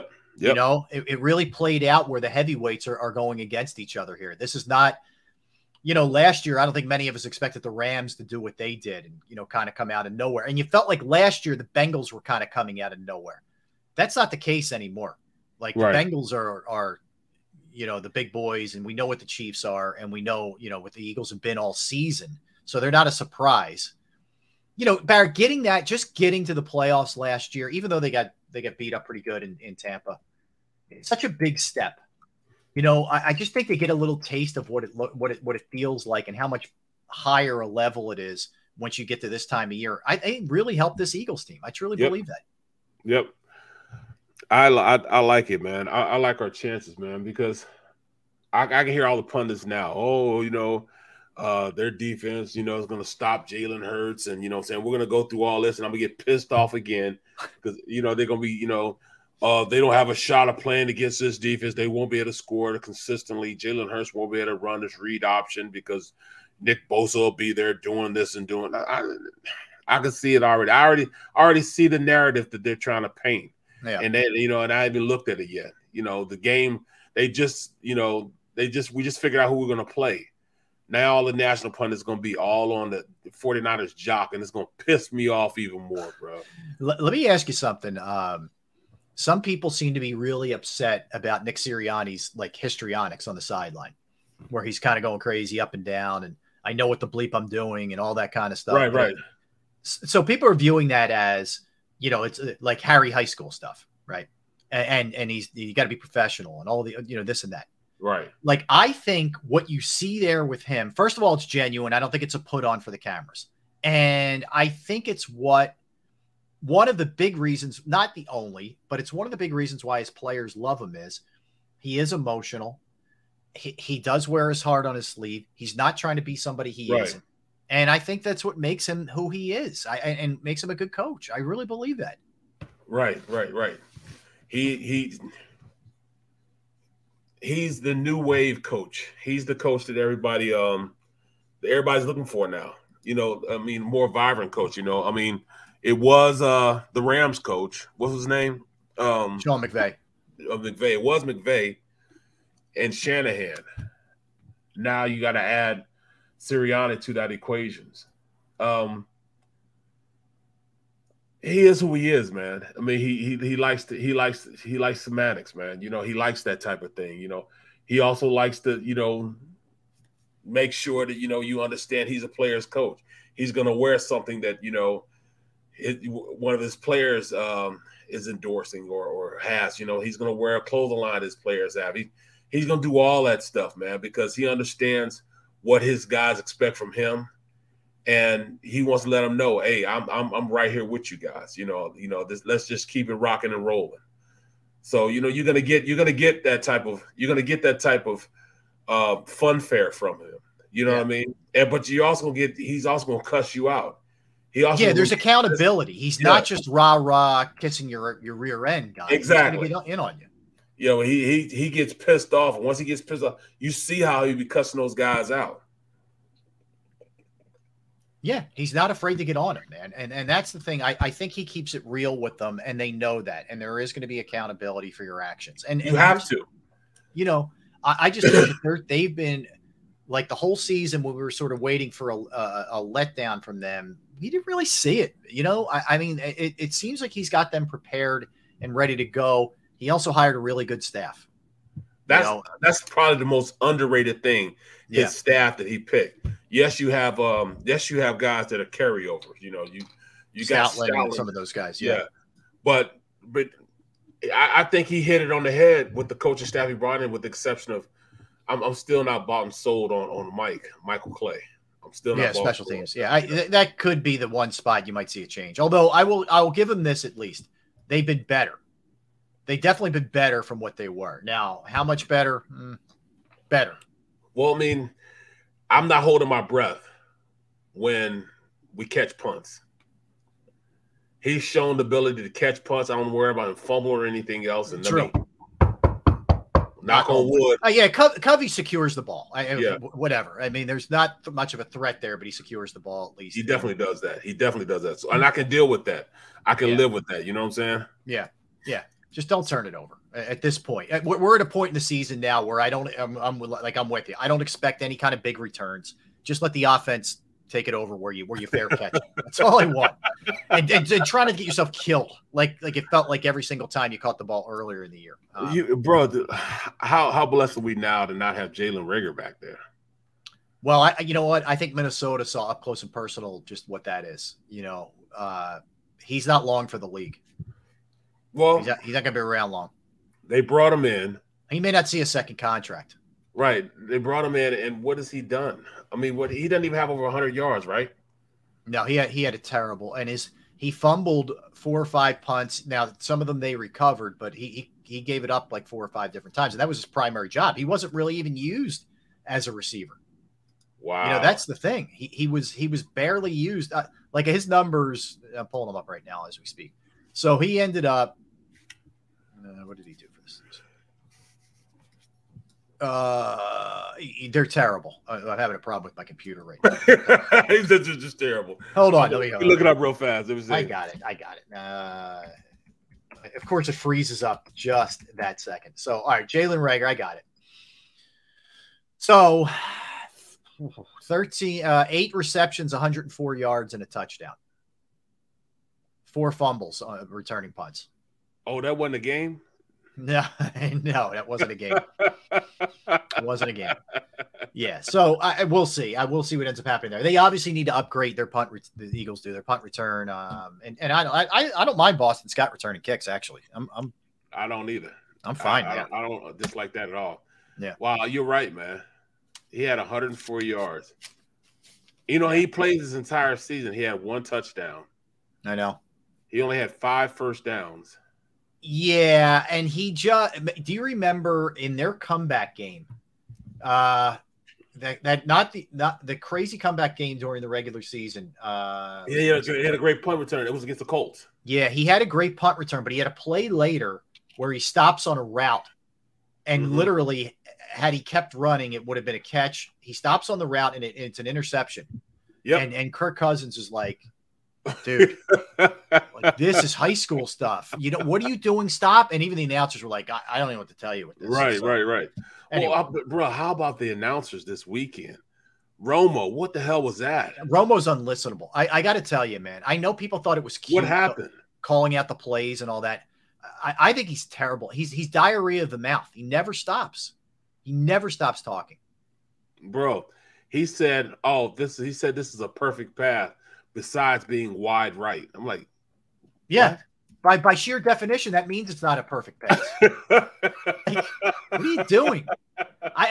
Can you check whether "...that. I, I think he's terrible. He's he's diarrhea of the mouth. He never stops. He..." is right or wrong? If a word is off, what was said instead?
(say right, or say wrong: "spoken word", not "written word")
right.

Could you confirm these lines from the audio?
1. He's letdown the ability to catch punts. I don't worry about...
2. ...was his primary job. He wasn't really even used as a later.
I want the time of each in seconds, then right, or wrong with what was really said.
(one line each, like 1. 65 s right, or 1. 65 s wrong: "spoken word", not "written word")
1. 281 s wrong: "shown", not "letdown"
2. 346 s wrong: "receiver", not "later".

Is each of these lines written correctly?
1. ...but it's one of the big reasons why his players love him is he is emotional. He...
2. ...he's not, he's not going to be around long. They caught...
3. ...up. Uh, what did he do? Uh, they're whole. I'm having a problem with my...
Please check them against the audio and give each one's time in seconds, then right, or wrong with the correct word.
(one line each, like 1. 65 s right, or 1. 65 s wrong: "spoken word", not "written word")
1. 118 s right
2. 328 s wrong: "brought", not "caught"
3. 357 s wrong: "terrible", not "whole".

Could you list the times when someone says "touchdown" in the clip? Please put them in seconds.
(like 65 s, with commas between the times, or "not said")
383 s, 414 s.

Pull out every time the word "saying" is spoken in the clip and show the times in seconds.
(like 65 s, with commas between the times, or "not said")
54 s, 297 s.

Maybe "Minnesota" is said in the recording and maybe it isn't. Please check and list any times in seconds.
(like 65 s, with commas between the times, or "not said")
321 s.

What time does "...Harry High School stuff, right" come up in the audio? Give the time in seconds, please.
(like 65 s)
102 s.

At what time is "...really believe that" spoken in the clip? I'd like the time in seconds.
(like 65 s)
131 s.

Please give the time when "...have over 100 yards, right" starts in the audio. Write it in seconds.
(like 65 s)
336 s.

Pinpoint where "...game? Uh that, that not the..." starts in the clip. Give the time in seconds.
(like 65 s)
422 s.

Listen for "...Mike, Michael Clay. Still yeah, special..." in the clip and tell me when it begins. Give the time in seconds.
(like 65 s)
260 s.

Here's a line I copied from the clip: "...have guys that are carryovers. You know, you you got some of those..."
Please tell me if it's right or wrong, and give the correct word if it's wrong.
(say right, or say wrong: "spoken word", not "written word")
right.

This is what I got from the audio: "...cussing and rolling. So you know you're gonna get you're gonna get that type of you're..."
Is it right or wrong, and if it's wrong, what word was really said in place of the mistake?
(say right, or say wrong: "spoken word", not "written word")
wrong: "rocking", not "cussing".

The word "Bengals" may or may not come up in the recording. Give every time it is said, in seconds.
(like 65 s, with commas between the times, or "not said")
11 s, 16 s.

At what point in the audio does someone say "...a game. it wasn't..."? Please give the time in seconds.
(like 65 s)
391 s.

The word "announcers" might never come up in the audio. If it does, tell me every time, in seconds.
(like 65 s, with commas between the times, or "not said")
449 s, 453 s.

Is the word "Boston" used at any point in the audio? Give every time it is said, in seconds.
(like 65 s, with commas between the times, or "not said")
401 s.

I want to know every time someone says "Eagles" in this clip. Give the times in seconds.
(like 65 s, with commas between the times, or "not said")
21 s, 41 s, 398 s.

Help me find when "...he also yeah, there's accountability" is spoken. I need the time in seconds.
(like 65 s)
204 s.